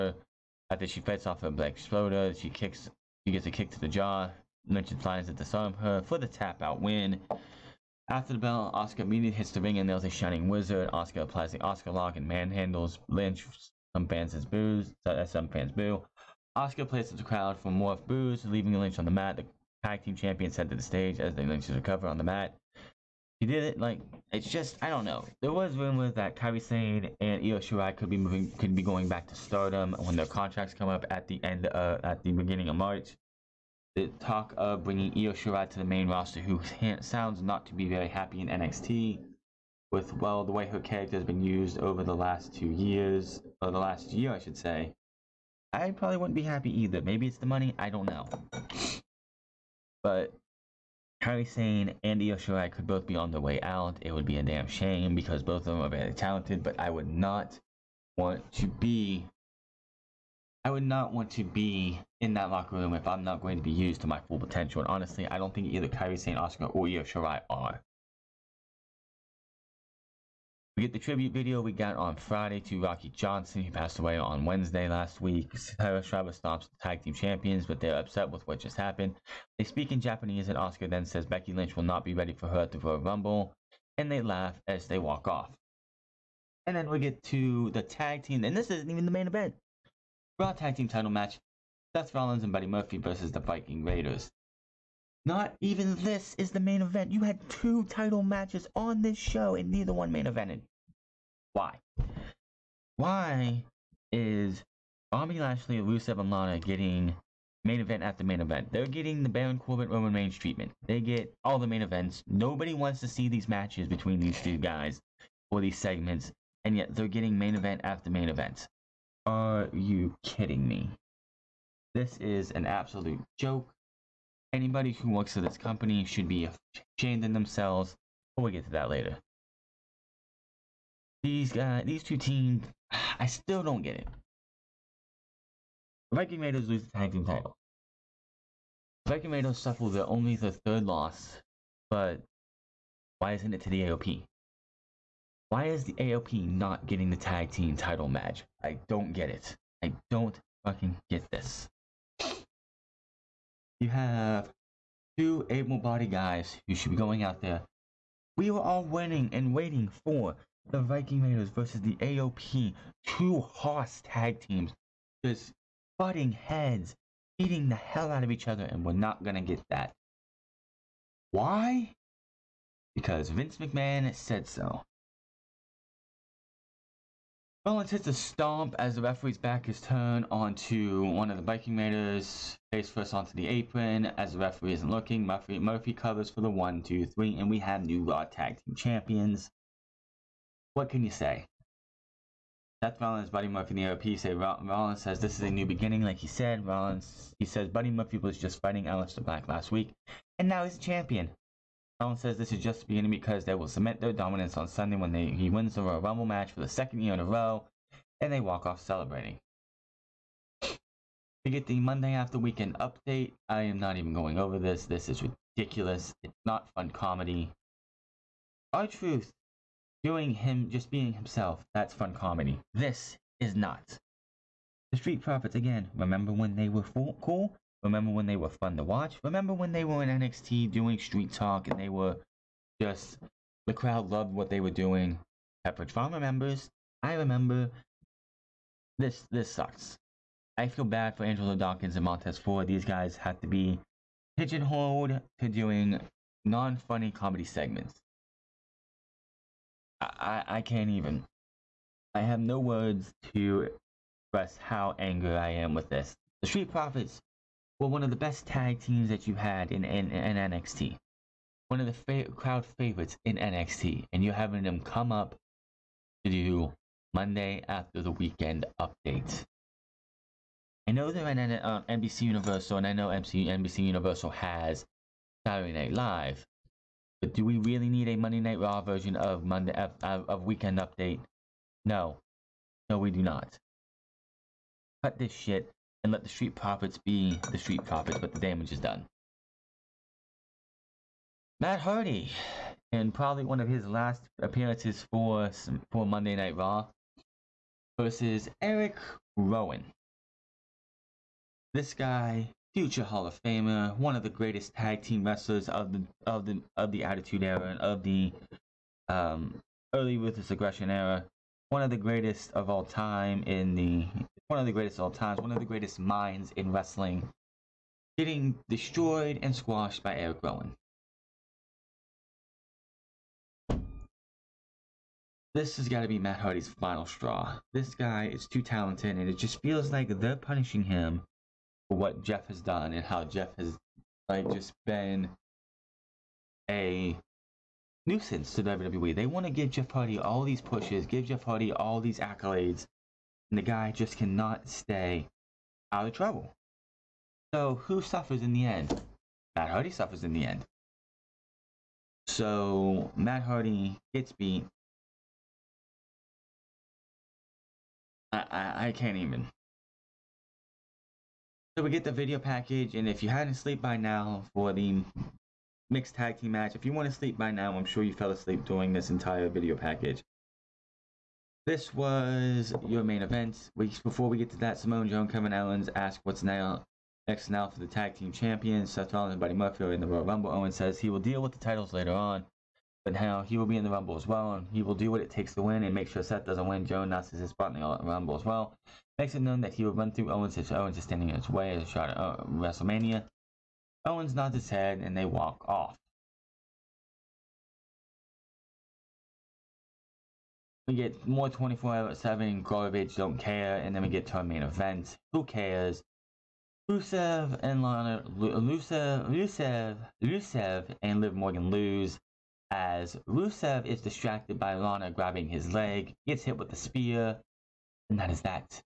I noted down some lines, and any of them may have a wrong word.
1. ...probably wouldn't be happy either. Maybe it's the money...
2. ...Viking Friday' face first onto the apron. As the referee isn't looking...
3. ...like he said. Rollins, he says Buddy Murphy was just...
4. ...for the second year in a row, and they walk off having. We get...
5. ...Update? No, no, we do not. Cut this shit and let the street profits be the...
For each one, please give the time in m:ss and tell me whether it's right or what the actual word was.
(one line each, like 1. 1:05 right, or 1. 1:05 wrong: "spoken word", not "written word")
1. 0:45 right
2. 3:01 wrong: "Raiders", not "Friday"
3. 3:16 right
4. 3:26 wrong: "celebrating", not "having"
5. 4:40 right.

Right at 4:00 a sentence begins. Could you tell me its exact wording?
I feel bad for Angelo Dawkins and Montez Ford.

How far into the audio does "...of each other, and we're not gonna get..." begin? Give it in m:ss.
2:48.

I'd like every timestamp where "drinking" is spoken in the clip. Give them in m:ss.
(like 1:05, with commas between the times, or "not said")
not said.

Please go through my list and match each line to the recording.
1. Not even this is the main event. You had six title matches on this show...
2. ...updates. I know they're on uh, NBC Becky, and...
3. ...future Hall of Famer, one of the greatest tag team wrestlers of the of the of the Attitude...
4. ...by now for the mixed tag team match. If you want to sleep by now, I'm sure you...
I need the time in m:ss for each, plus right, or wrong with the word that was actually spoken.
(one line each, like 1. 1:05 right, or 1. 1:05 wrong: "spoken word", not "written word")
1. 1:35 wrong: "two", not "six"
2. 4:28 wrong: "Universal", not "Becky"
3. 5:02 right
4. 6:03 right.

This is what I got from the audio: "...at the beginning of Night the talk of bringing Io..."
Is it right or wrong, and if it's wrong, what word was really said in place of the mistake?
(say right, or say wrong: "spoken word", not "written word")
wrong: "March", not "Night".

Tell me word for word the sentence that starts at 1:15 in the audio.
Sarah Schreiber stops the tag team champions, but they're upset with what just happened.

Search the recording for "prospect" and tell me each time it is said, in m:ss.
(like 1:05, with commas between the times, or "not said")
not said.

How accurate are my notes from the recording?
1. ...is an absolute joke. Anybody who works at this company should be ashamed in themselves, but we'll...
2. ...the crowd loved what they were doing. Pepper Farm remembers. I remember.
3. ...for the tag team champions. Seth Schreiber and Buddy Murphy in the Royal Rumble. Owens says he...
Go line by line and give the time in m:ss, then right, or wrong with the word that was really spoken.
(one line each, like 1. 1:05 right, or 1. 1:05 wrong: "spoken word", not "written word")
1. 2:02 right
2. 3:53 right
3. 6:17 wrong: "Rollins", not "Schreiber".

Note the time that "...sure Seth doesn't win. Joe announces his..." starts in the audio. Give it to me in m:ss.
6:26.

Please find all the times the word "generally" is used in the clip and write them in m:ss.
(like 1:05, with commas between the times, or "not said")
not said.